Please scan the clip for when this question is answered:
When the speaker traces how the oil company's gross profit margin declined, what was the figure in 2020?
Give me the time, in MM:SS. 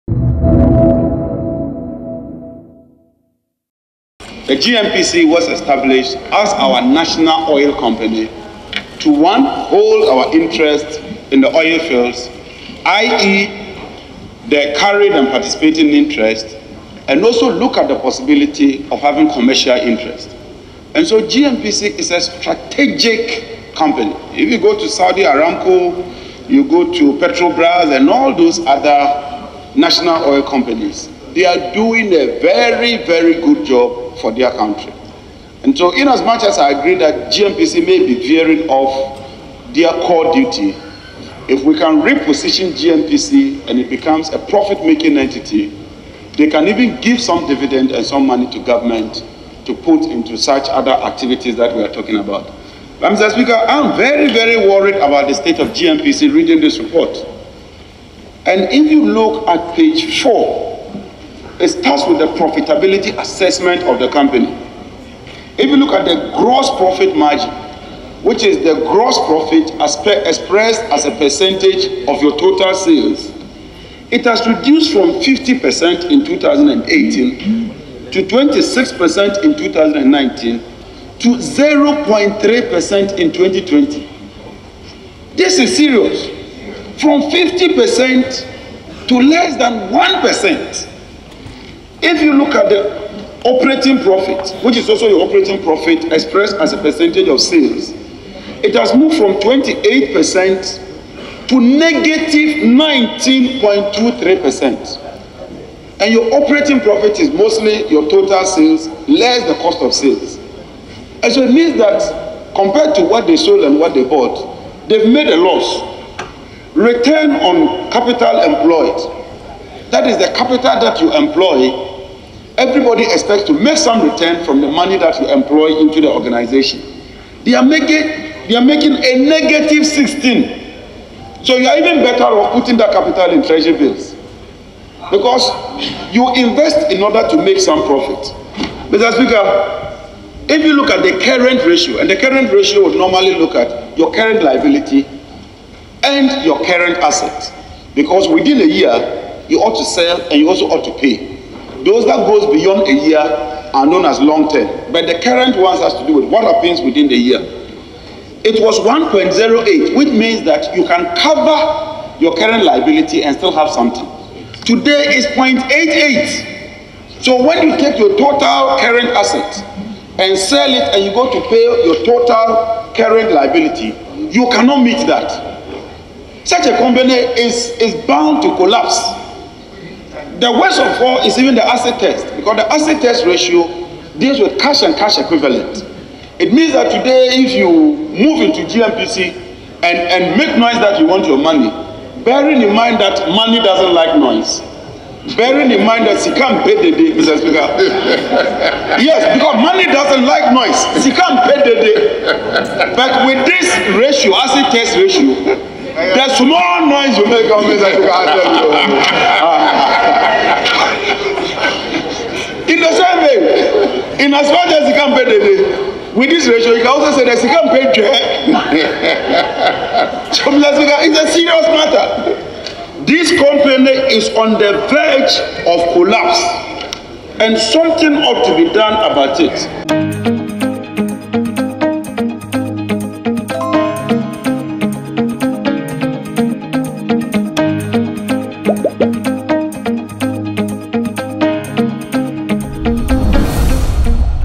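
01:21.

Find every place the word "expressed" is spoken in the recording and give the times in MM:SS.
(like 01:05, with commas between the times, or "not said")
01:10, 01:36.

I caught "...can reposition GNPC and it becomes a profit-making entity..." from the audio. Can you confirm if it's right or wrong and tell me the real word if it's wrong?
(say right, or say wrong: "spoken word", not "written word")
right.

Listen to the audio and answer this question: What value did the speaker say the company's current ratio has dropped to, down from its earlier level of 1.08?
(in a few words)
0.88.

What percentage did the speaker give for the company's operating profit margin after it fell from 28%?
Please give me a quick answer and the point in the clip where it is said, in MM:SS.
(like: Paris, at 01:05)
-19.23%, at 01:41.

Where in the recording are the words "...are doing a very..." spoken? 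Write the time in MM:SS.
00:31.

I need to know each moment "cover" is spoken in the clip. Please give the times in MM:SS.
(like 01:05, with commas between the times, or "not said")
02:41.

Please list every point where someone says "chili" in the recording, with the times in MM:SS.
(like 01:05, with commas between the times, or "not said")
not said.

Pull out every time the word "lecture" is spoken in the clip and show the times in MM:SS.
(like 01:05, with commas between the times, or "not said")
not said.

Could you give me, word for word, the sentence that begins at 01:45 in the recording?
And your operating profit is mostly your total sales less the cost of sales.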